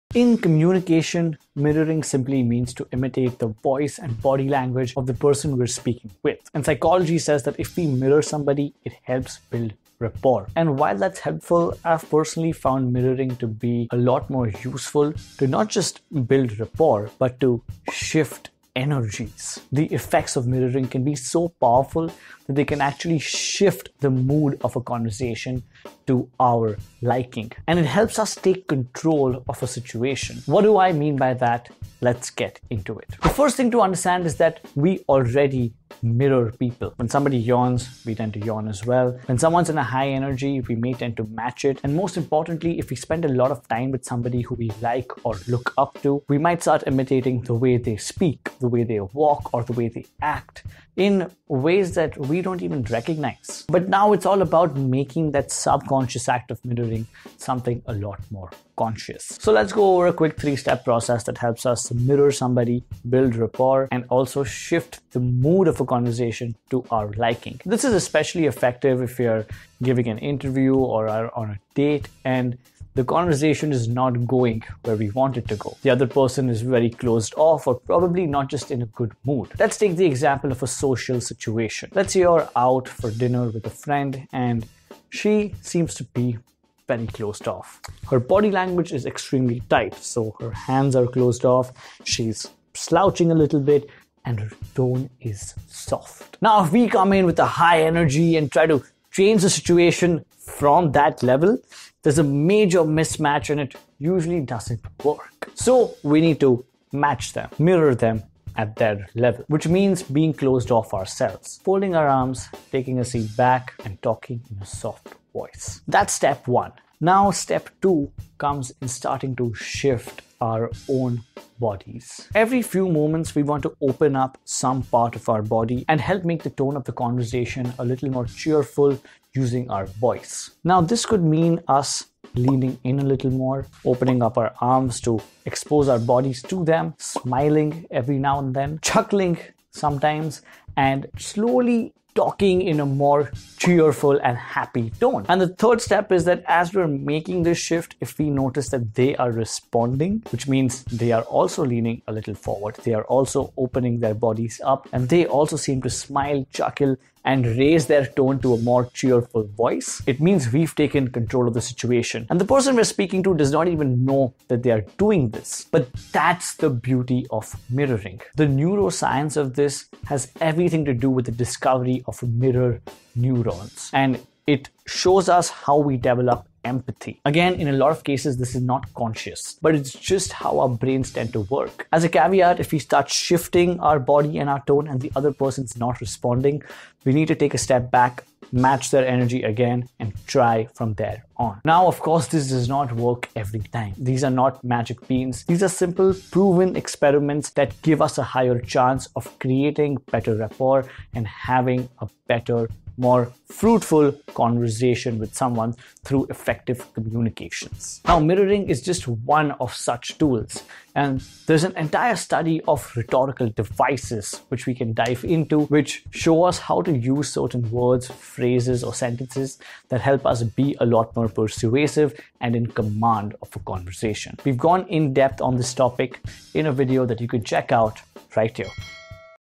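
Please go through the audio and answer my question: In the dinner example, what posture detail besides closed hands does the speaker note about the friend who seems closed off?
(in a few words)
slouching.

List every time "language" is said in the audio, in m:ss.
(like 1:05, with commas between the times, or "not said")
0:04, 1:28.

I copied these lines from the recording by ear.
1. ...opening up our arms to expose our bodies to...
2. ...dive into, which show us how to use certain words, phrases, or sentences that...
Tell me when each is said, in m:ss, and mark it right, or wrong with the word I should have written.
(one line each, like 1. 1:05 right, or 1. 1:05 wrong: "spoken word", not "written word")
1. 2:13 right
2. 3:34 right.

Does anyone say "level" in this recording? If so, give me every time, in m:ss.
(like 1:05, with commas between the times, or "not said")
1:41, 1:49.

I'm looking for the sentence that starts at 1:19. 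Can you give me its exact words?
Let's take the example of a social situation.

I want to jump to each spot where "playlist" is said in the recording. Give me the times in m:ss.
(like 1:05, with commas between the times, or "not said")
not said.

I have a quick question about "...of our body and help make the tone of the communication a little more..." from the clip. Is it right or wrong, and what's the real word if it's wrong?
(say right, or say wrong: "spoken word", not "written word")
wrong: "conversation", not "communication".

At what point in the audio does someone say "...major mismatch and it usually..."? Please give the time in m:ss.
1:42.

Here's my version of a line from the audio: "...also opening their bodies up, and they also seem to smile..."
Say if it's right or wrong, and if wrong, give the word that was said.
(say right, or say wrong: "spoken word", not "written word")
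right.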